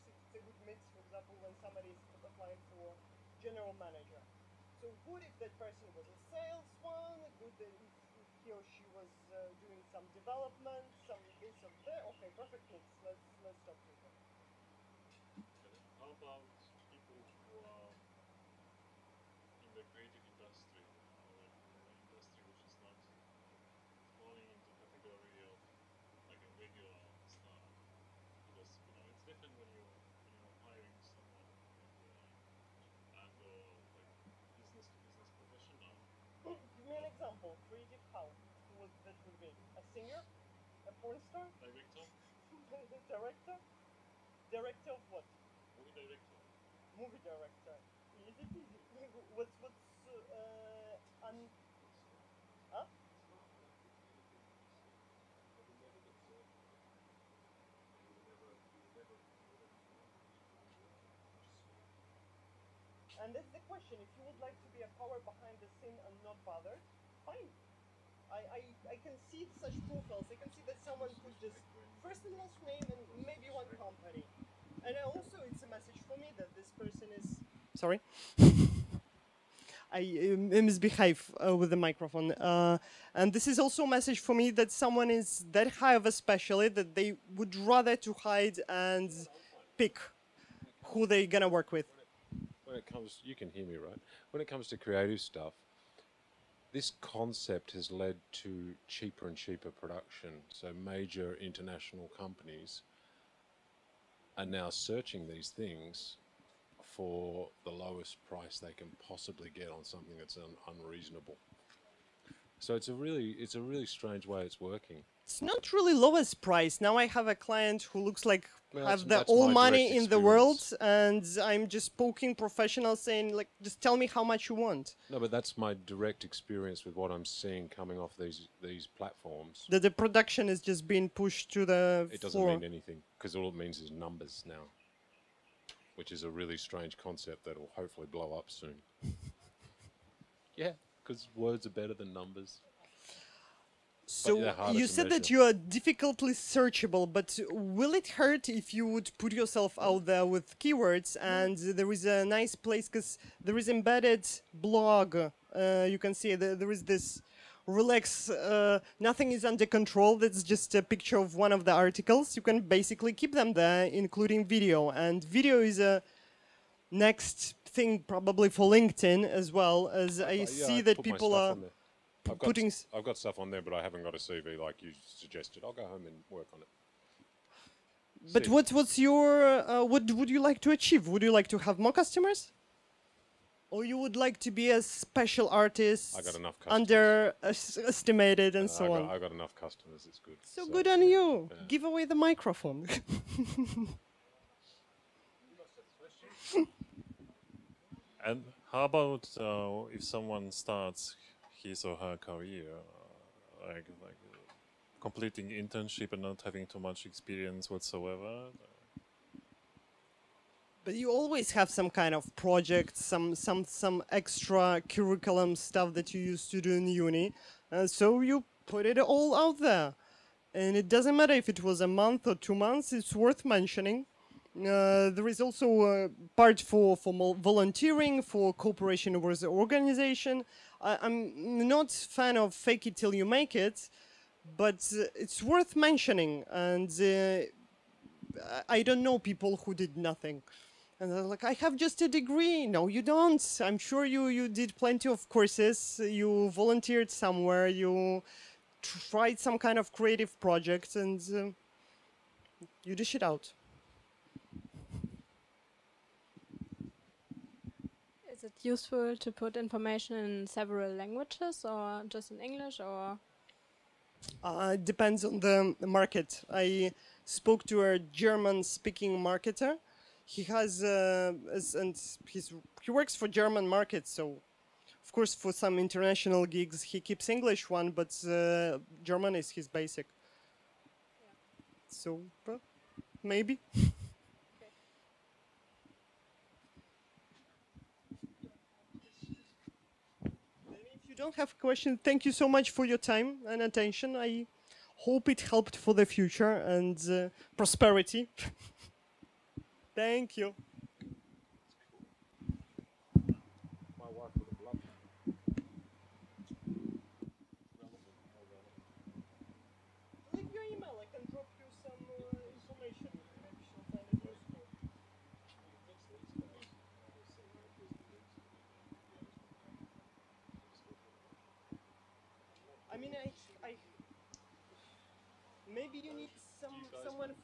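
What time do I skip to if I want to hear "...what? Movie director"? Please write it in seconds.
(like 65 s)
45 s.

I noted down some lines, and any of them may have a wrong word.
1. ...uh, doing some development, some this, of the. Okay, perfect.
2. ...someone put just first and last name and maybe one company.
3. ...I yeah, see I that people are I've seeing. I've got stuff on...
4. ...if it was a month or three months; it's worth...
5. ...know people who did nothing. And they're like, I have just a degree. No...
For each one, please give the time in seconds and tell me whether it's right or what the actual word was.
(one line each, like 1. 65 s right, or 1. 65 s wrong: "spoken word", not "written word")
1. 9 s right
2. 70 s right
3. 170 s wrong: "putting", not "seeing"
4. 221 s wrong: "two", not "three"
5. 239 s right.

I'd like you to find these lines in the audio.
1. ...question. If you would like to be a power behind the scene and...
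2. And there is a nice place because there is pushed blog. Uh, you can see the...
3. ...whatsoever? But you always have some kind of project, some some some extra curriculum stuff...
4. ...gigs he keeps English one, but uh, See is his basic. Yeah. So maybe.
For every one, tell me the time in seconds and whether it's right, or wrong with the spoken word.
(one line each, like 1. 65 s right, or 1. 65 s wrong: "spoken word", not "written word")
1. 63 s right
2. 151 s wrong: "embedded", not "pushed"
3. 207 s right
4. 276 s wrong: "German", not "See".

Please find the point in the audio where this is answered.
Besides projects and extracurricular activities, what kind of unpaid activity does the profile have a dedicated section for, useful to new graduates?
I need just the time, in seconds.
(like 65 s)
227 s.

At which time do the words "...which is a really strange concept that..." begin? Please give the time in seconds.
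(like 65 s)
135 s.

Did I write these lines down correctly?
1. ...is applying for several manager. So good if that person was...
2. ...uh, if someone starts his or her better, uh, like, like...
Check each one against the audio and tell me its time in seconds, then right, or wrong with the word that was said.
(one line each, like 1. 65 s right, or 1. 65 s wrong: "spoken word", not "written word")
1. 1 s wrong: "general", not "several"
2. 199 s wrong: "career", not "better".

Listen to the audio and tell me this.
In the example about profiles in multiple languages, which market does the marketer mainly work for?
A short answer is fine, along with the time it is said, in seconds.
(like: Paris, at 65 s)
German market, at 273 s.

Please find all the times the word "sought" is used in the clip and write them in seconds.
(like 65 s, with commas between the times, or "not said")
not said.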